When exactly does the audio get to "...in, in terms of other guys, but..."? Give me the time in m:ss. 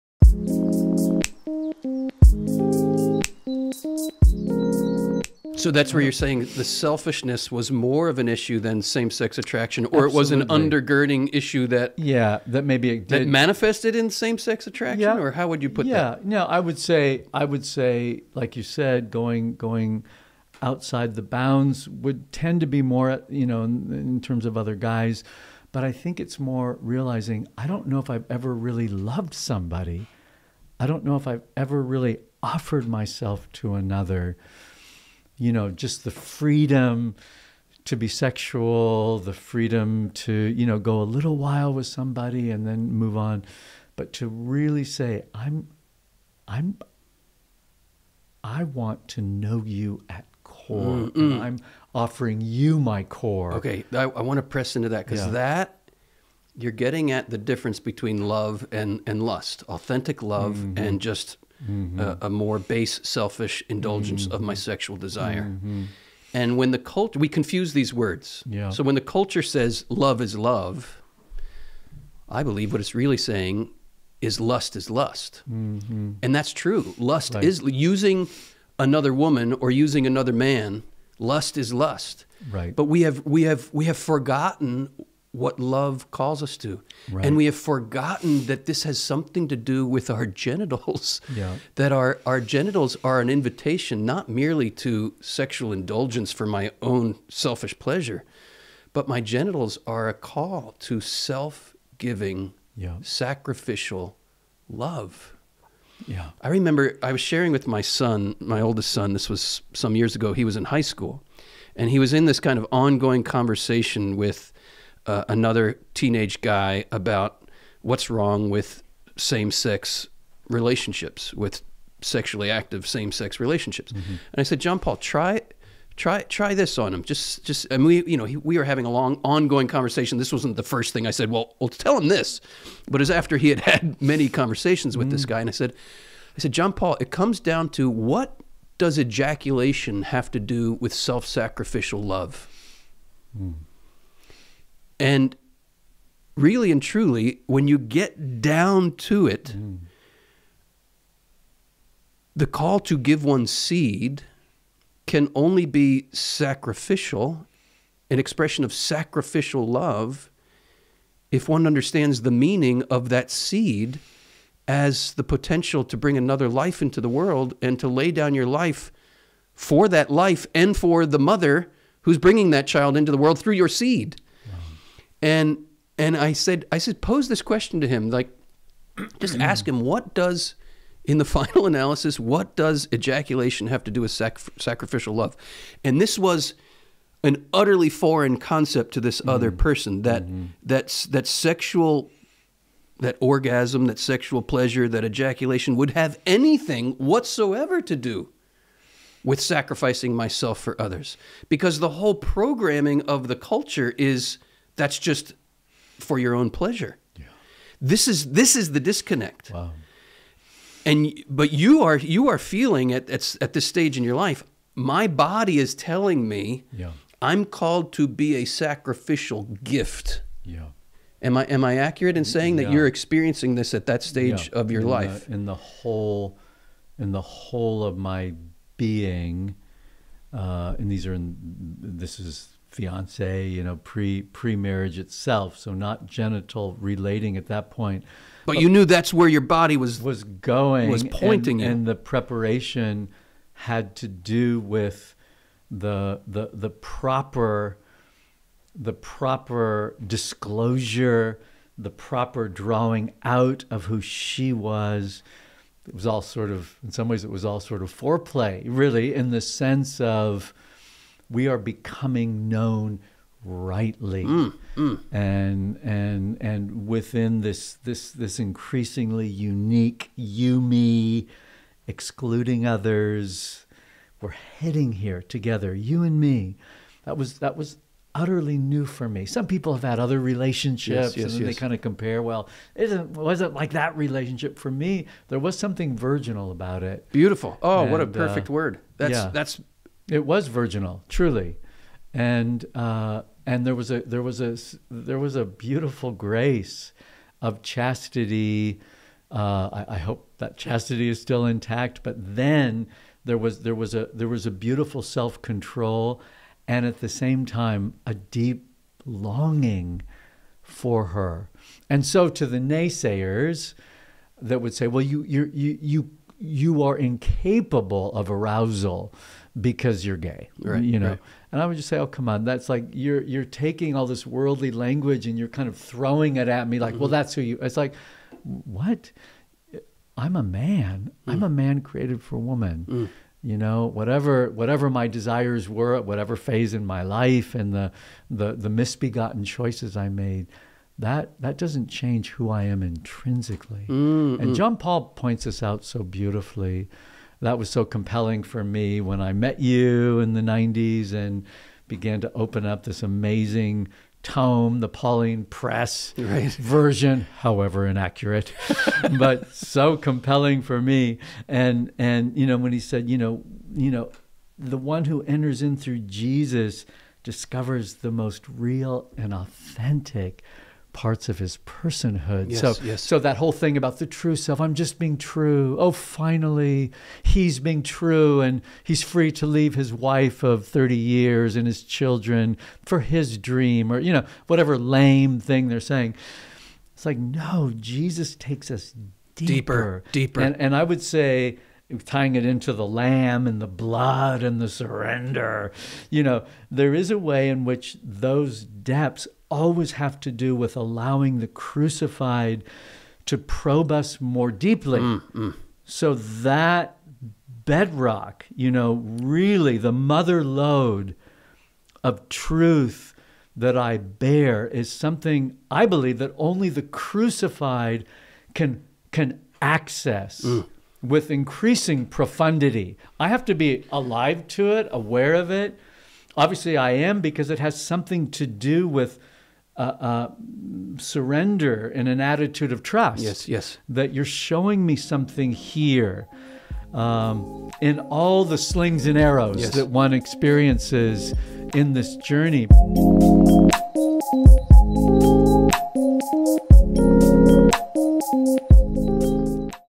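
0:23.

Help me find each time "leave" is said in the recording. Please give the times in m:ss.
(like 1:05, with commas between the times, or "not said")
6:19.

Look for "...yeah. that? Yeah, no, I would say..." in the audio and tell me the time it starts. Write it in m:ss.
0:15.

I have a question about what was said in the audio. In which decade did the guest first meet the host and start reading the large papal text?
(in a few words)
the 1990s.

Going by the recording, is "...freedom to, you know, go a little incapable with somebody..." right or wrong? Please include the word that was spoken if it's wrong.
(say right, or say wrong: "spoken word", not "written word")
wrong: "while", not "incapable".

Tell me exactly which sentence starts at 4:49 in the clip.
that's it was virginal, truly, and uh, and there was a there was a there was a beautiful grace of chastity.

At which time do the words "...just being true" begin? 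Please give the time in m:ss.
6:14.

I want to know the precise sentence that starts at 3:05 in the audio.
And this was an utterly foreign concept to this other mm-hmm.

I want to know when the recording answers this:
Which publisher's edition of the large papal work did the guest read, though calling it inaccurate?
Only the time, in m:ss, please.
5:54.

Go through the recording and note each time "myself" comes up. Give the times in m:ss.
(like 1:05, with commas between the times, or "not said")
0:32, 3:20.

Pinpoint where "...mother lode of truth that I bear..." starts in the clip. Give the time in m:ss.
6:49.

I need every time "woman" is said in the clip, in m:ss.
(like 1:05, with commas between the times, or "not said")
1:19, 5:32.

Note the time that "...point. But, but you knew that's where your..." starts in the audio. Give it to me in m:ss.
3:57.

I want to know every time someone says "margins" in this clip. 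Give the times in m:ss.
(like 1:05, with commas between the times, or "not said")
not said.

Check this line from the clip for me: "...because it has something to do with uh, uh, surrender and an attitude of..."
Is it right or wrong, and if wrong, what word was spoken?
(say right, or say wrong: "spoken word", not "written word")
right.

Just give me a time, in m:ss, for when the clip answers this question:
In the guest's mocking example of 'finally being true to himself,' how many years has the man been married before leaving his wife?
6:20.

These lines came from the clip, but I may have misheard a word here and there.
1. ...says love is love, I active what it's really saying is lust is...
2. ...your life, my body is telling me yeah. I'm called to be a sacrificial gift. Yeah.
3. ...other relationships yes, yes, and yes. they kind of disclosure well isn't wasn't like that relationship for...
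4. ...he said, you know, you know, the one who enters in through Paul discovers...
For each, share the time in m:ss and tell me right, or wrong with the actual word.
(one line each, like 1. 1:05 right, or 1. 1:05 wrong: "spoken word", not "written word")
1. 1:09 wrong: "believe", not "active"
2. 3:34 right
3. 4:39 wrong: "compare", not "disclosure"
4. 6:02 wrong: "Jesus", not "Paul".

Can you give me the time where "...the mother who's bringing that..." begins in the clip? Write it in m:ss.
2:51.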